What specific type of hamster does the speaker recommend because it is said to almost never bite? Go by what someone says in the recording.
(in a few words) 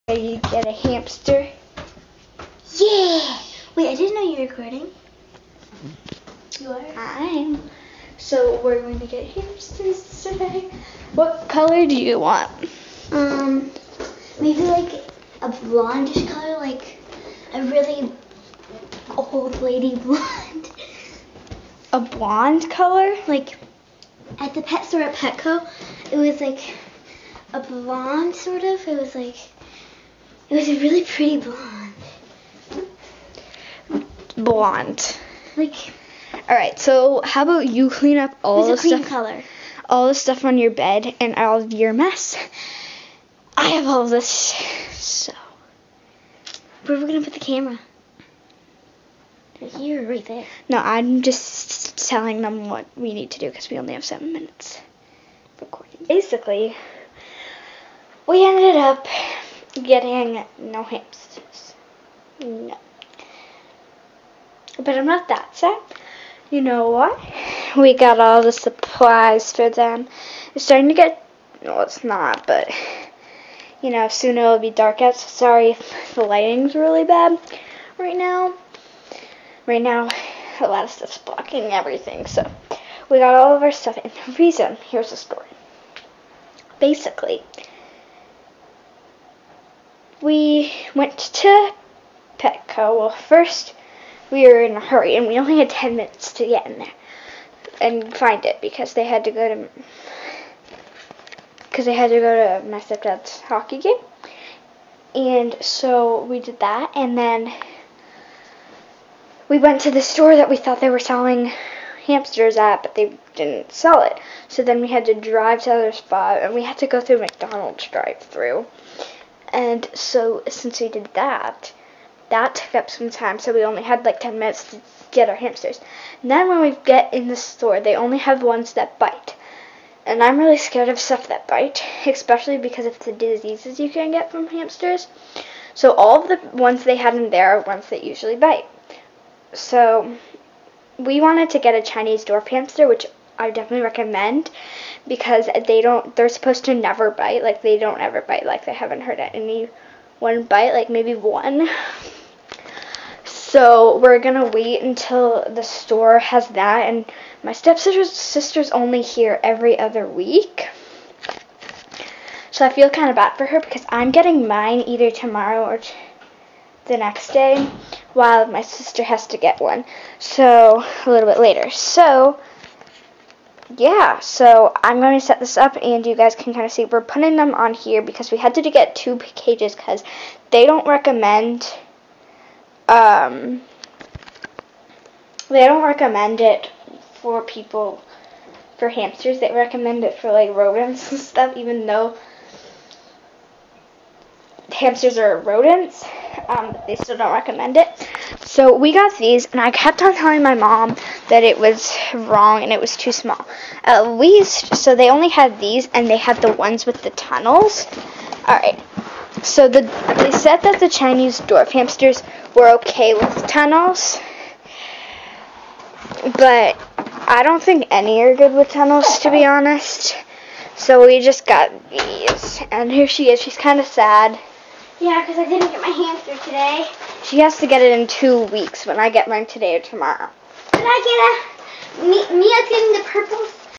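Chinese dwarf hamster.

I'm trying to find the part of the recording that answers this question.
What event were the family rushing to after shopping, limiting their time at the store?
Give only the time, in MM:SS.
01:42.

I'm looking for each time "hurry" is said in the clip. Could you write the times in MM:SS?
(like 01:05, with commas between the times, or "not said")
01:34.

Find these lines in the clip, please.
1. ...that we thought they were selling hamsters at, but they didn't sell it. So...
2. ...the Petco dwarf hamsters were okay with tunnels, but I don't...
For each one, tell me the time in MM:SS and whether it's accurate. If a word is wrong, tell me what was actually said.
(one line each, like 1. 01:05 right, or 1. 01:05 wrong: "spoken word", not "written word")
1. 01:50 right
2. 03:30 wrong: "Chinese", not "Petco".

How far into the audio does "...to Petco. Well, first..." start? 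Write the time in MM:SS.
01:31.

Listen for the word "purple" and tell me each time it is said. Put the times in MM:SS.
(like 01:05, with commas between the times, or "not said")
03:53.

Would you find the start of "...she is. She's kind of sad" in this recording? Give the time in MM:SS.
03:43.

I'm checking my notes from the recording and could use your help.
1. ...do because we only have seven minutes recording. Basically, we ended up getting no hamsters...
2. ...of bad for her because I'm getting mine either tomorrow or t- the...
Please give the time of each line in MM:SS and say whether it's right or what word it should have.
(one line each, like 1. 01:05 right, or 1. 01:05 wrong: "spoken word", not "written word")
1. 00:53 right
2. 02:43 right.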